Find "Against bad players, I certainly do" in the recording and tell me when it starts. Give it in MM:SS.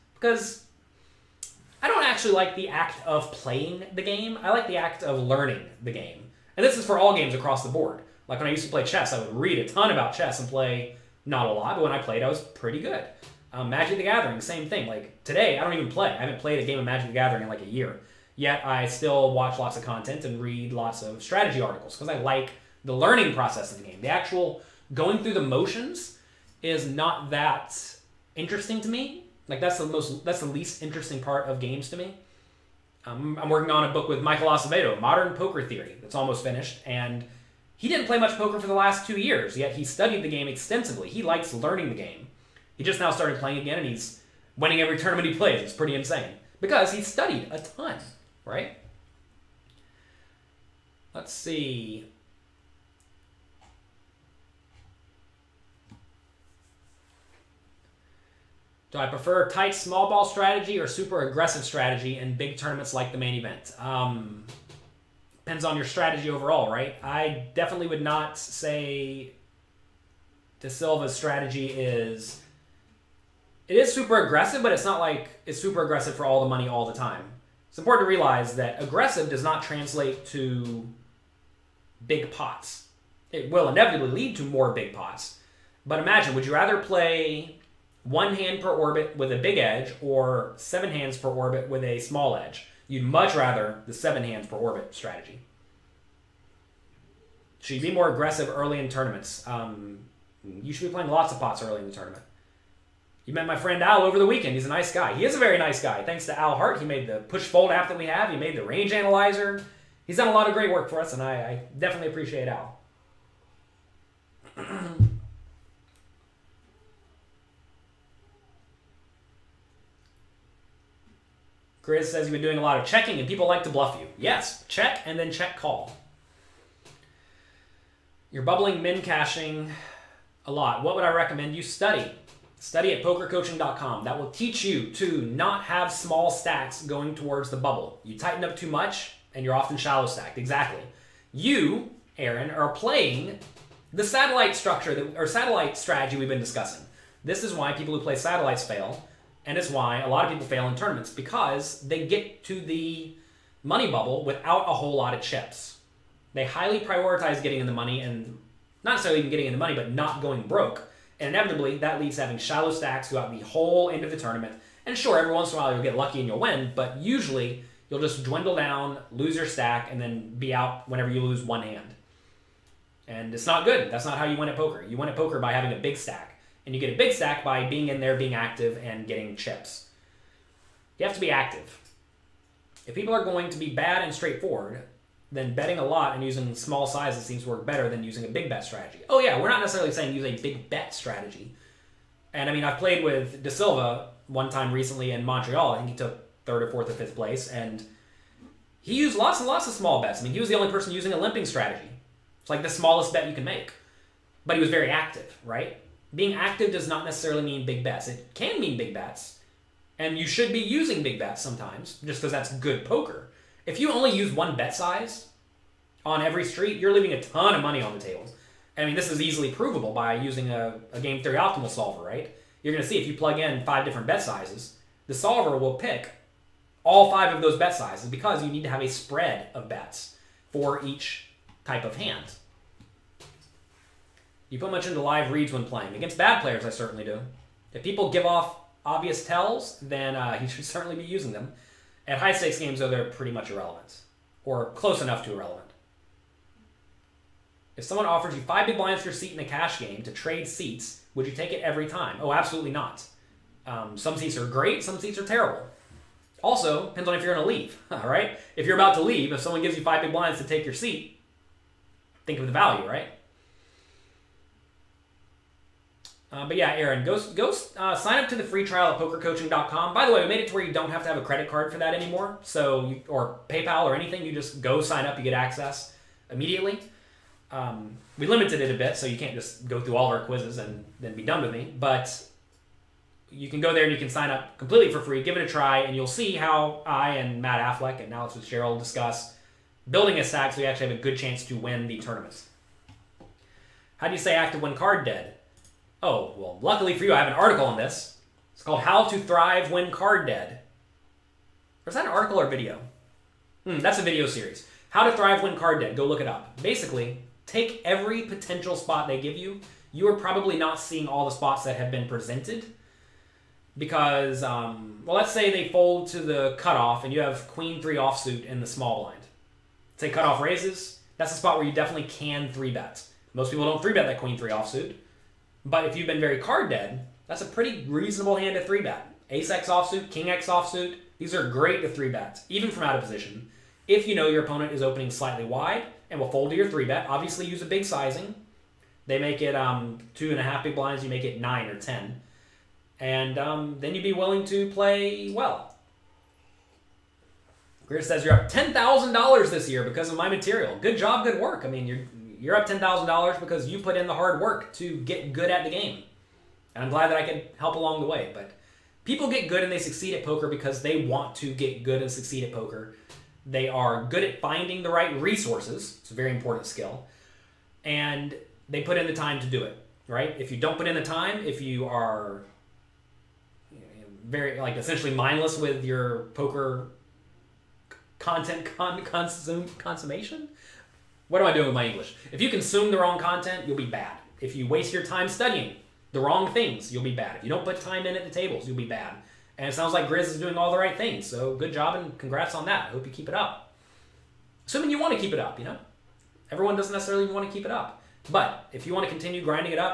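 03:55.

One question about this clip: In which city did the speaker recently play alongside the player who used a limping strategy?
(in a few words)
Montreal.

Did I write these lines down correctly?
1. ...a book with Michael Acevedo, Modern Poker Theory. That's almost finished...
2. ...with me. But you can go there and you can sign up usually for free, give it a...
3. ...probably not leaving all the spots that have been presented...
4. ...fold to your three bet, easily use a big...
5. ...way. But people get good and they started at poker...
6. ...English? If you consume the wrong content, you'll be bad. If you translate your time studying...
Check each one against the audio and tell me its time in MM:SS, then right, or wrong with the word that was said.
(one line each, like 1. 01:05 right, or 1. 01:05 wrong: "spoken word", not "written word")
1. 00:33 right
2. 04:41 wrong: "completely", not "usually"
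3. 05:10 wrong: "seeing", not "leaving"
4. 05:36 wrong: "obviously", not "easily"
5. 05:58 wrong: "succeed", not "started"
6. 06:21 wrong: "waste", not "translate".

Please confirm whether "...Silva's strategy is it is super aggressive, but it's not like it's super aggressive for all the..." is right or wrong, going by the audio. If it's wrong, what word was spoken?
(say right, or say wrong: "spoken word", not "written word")
right.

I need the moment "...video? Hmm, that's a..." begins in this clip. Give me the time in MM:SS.
05:02.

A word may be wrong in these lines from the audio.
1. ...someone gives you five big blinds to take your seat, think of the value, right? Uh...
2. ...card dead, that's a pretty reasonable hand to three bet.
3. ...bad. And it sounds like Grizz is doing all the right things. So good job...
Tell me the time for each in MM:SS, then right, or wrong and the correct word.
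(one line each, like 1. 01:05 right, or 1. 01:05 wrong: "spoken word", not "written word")
1. 04:19 right
2. 05:26 right
3. 06:28 right.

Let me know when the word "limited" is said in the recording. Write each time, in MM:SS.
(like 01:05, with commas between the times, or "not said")
04:38.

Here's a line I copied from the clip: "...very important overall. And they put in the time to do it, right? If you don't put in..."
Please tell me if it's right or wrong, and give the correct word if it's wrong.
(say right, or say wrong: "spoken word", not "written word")
wrong: "skill", not "overall".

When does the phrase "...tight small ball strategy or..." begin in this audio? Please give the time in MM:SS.
00:59.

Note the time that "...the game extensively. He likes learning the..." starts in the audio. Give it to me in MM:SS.
00:40.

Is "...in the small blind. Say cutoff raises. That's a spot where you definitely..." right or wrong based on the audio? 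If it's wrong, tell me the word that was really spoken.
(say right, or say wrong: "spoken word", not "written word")
right.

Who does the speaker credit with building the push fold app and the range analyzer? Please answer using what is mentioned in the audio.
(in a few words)
Al Hart.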